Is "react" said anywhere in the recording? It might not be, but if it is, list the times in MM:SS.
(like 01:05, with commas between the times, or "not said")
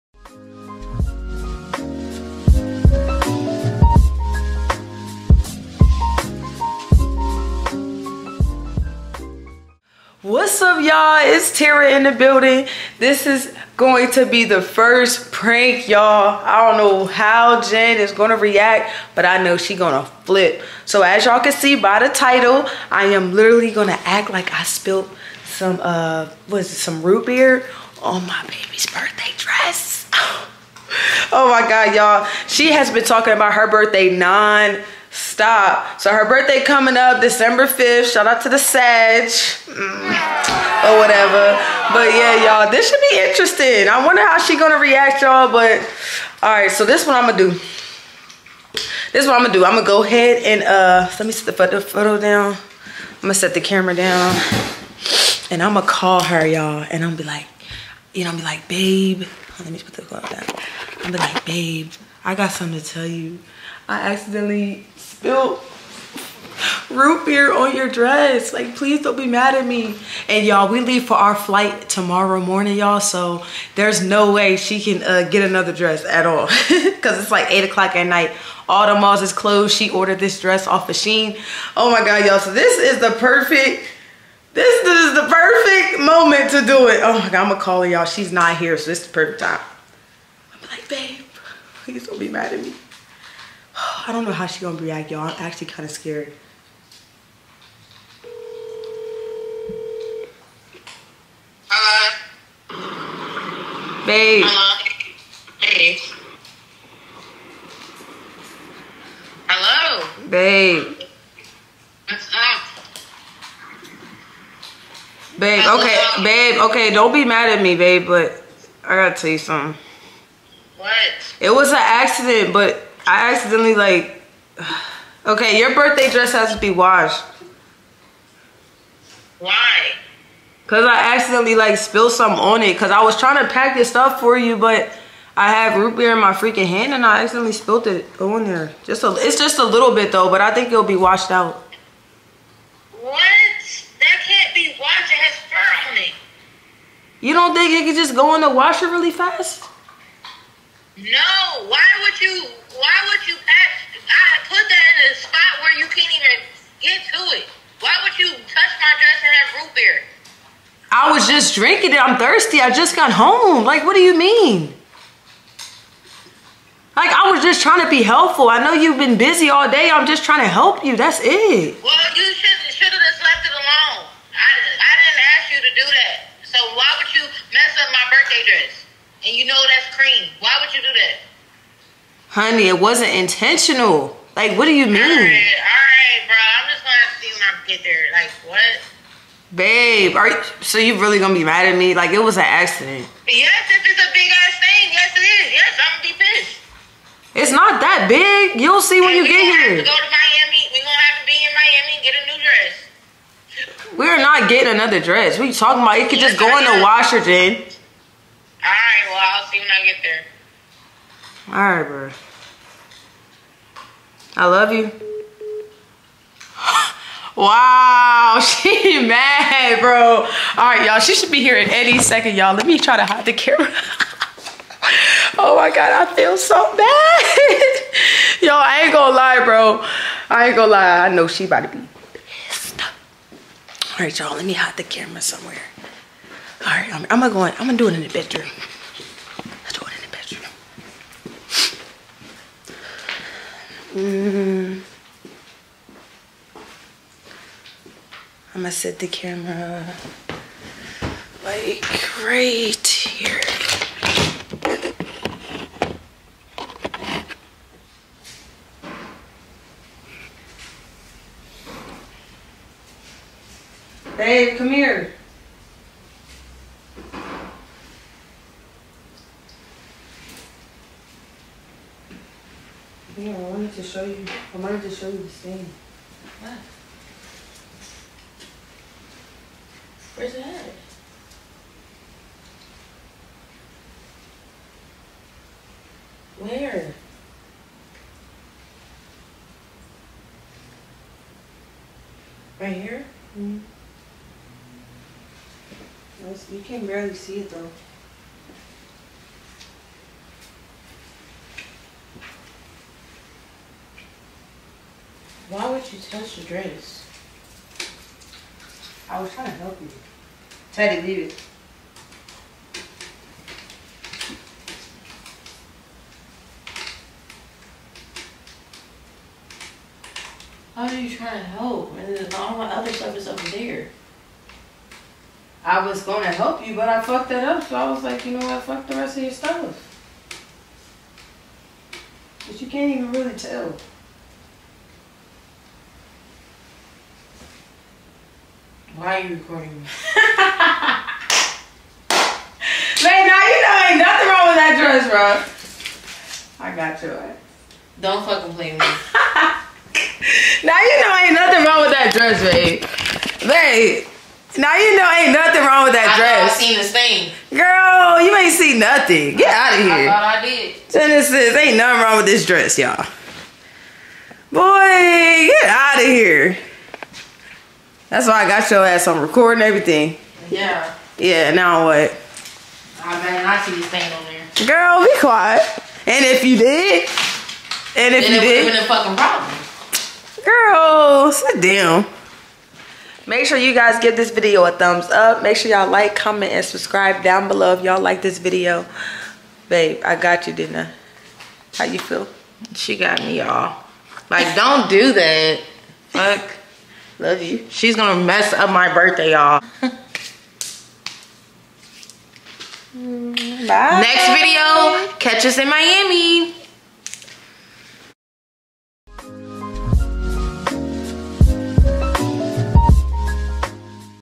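00:18, 00:44, 01:34.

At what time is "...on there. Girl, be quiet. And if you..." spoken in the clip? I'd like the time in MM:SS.
06:14.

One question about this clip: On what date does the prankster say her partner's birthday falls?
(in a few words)
December 5.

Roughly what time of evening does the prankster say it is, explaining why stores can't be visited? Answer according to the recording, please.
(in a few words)
8 o'clock.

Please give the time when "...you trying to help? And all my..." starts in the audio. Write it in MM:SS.
05:20.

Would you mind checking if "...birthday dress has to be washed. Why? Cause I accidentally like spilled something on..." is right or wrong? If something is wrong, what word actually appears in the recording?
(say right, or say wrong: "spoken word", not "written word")
right.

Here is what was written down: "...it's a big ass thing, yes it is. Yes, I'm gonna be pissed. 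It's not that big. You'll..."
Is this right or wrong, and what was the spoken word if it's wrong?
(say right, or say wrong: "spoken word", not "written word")
right.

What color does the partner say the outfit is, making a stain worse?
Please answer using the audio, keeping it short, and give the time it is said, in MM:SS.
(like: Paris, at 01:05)
Cream, at 02:59.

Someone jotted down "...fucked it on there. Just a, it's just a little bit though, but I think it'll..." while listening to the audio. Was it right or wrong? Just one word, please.
wrong.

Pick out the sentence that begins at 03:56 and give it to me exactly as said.
All right, I'm, I'm gonna go in, I'm gonna do it in the bedroom.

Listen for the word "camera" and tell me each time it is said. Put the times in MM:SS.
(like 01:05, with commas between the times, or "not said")
00:53, 03:43, 03:54, 04:09.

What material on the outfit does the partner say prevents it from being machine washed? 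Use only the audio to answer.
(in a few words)
Fur.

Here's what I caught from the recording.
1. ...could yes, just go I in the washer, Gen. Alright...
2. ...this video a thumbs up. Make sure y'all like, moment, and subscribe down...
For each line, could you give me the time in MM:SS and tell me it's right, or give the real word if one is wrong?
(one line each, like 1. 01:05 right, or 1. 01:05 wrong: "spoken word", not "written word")
1. 03:26 right
2. 06:24 wrong: "comment", not "moment".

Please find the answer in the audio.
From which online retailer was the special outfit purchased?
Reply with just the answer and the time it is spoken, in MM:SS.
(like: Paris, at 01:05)
Shein, at 01:20.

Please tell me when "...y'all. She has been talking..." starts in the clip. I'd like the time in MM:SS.
00:31.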